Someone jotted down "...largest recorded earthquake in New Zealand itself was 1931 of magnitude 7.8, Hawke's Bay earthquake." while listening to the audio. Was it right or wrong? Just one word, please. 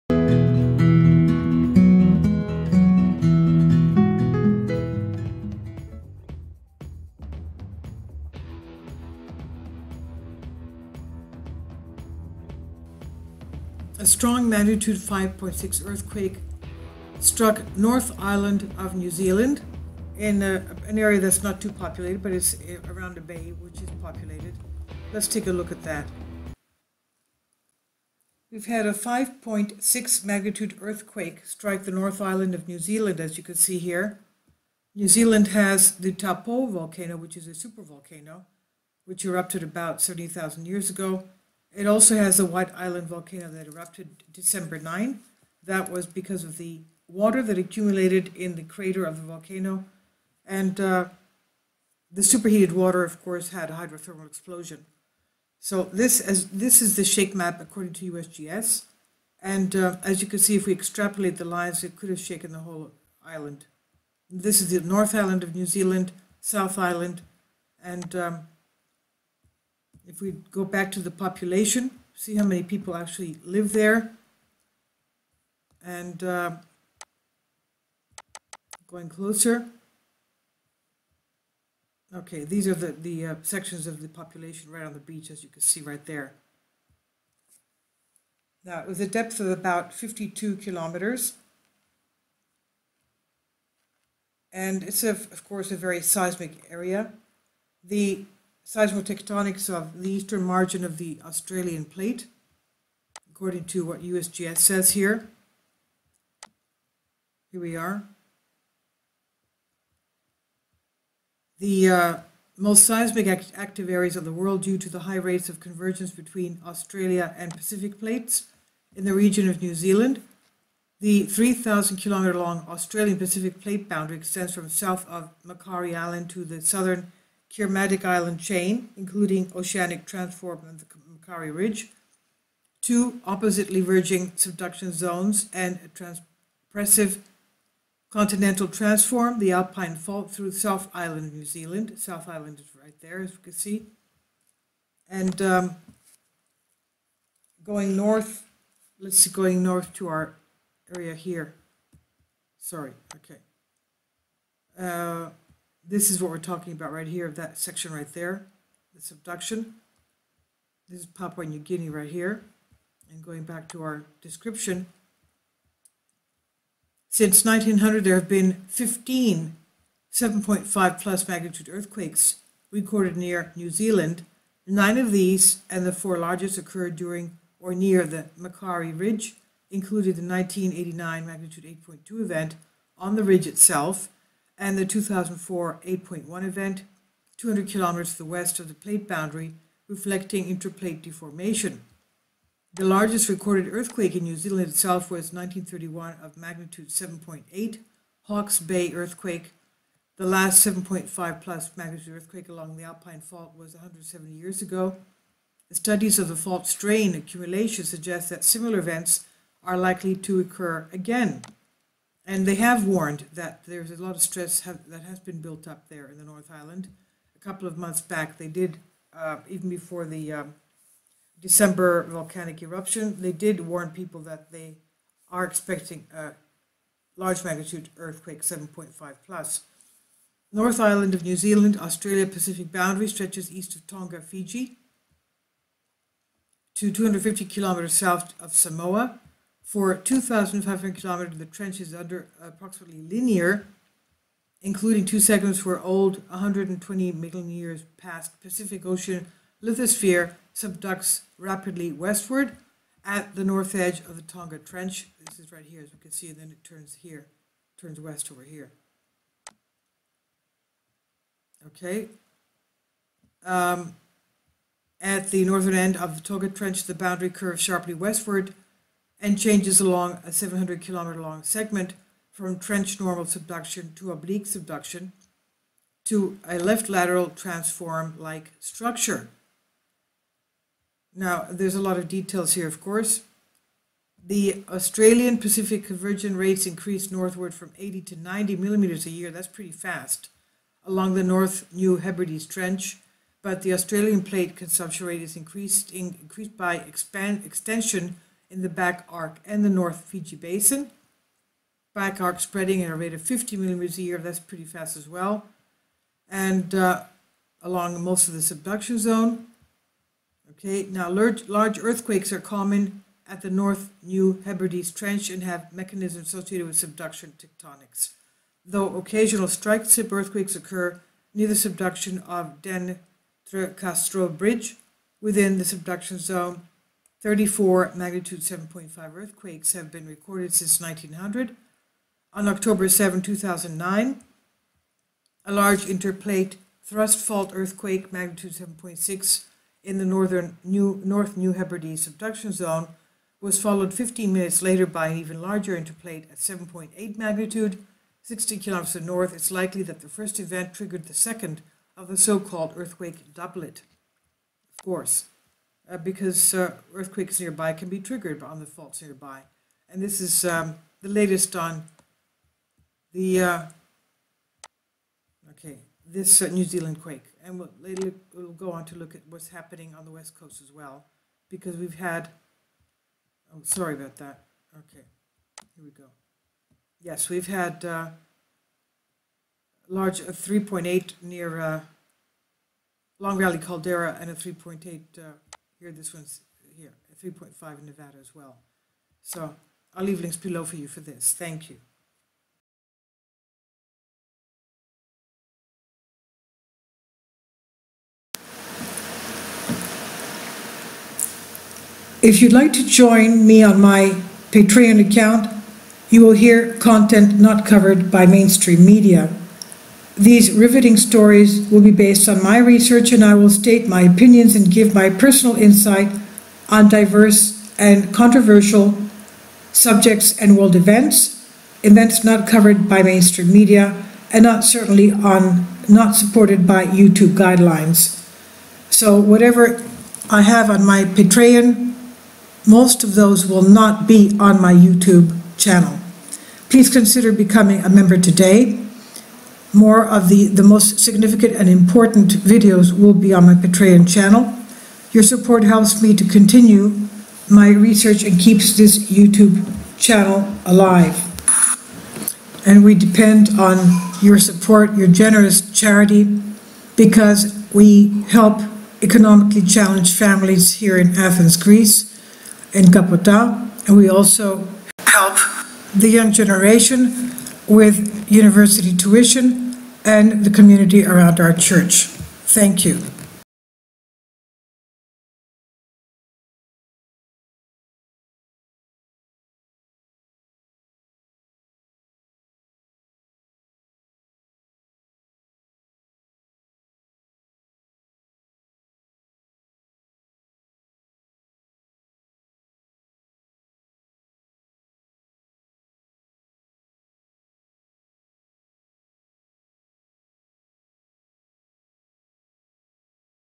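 right.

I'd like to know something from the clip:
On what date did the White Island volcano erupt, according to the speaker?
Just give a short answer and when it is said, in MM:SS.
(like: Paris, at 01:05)
December 9, at 00:44.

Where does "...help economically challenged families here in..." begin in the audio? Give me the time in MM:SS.
07:38.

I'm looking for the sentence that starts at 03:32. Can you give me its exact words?
And they have warned that there's a lot of stress have, that has been built up there in the North Island.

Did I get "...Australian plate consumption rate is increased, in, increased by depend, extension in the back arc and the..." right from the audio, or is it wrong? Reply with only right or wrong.
wrong.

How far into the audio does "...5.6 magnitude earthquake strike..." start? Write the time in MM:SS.
00:28.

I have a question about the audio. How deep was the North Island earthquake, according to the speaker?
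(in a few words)
52 kilometers.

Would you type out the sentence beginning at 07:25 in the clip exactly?
Your support helps me to continue my research and keeps this YouTube channel alive.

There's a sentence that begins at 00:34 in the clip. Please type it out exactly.
New Zealand has the Taupo volcano, which is a supervolcano, which erupted about 70,000 years ago.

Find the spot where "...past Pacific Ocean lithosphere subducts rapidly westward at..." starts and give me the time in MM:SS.
04:07.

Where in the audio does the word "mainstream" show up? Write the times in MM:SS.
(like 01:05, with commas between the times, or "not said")
06:48, 07:03.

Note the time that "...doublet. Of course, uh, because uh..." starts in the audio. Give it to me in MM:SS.
05:53.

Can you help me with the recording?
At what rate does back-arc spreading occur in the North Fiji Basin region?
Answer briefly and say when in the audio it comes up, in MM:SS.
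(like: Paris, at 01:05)
50 millimeters a year, at 05:03.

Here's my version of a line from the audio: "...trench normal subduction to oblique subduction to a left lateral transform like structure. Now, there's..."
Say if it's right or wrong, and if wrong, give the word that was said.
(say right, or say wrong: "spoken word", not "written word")
right.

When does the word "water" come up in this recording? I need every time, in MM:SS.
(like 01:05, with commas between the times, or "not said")
00:47, 00:52.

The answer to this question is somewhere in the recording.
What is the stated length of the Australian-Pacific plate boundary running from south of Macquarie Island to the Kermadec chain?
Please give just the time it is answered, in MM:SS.
02:01.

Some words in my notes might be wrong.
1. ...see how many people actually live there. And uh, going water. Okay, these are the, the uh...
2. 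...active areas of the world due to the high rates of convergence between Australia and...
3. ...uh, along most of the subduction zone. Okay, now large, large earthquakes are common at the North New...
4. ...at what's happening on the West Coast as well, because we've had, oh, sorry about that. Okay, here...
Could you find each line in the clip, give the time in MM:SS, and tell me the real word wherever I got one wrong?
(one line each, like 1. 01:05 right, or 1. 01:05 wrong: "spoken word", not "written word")
1. 01:12 wrong: "closer", not "water"
2. 01:53 right
3. 05:06 right
4. 06:09 right.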